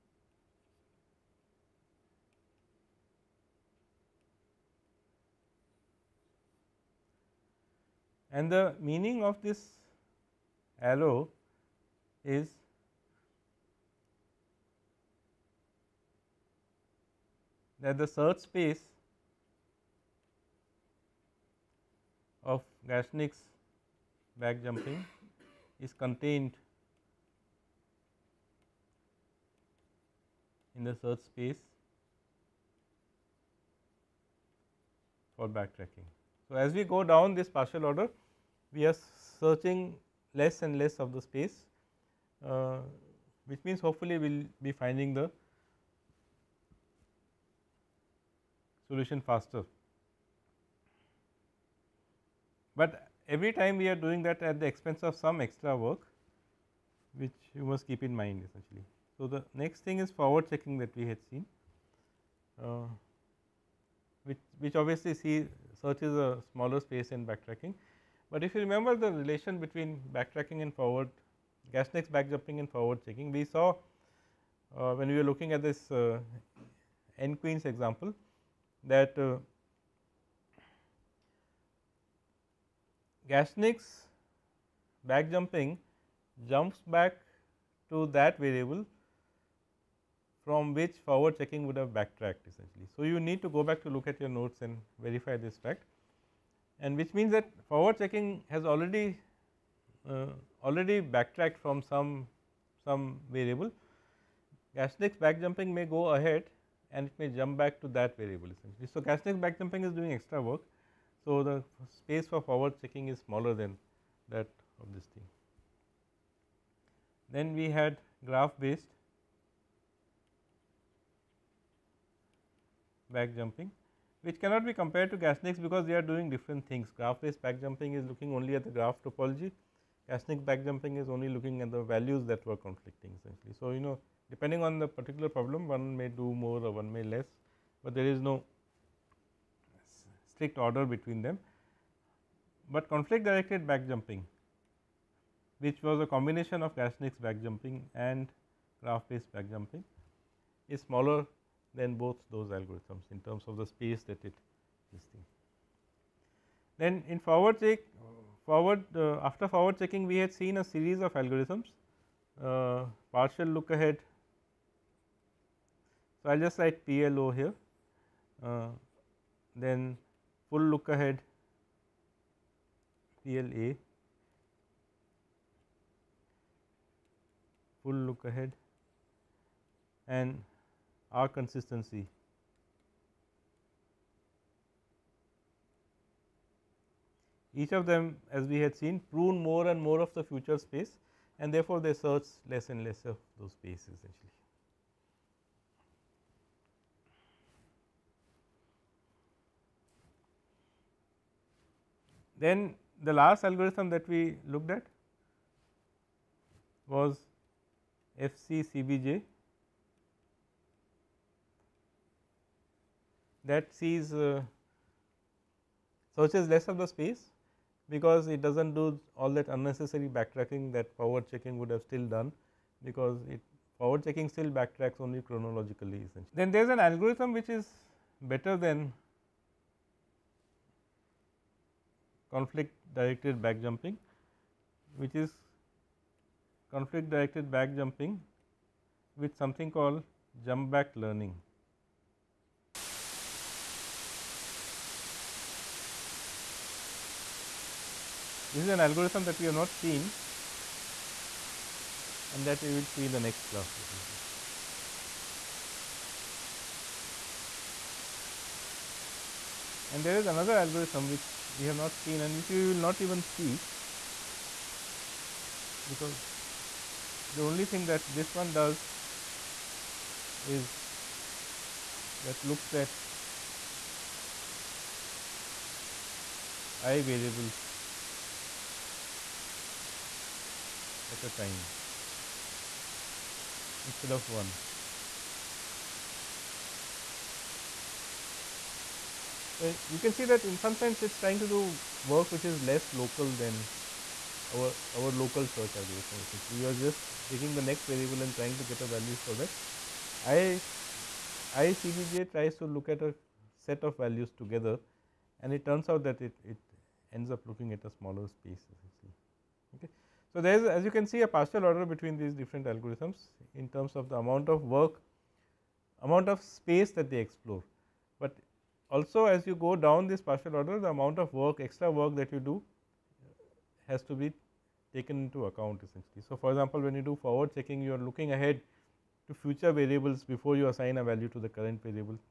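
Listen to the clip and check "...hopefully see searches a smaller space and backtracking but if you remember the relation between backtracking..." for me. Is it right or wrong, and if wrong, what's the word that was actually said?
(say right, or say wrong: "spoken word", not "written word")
wrong: "obviously", not "hopefully".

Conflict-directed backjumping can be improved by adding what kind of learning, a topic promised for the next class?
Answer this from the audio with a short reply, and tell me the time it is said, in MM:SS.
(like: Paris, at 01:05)
Jump back learning, at 04:00.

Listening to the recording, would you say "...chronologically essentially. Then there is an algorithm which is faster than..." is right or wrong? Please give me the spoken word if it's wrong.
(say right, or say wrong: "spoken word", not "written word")
wrong: "better", not "faster".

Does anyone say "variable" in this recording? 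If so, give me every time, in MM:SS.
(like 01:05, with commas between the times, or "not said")
01:28, 01:43, 01:48, 04:37, 04:57, 05:29.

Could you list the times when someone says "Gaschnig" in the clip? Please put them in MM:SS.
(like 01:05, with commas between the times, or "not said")
00:22, 01:11, 01:23, 01:44, 01:49, 02:05, 02:10, 02:26.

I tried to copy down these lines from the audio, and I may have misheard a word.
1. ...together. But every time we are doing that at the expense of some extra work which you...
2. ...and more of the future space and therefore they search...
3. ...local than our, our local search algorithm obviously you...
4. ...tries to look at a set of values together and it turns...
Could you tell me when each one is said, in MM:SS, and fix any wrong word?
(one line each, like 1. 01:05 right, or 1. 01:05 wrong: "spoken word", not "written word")
1. 00:49 wrong: "faster", not "together"
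2. 03:09 right
3. 04:52 wrong: "essentially", not "obviously"
4. 05:02 right.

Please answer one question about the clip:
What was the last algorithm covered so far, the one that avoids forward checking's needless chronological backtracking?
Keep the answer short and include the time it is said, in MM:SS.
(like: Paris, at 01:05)
FCCBJ, at 03:28.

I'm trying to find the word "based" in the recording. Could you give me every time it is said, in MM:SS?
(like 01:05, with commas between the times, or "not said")
01:58, 02:07, 02:29.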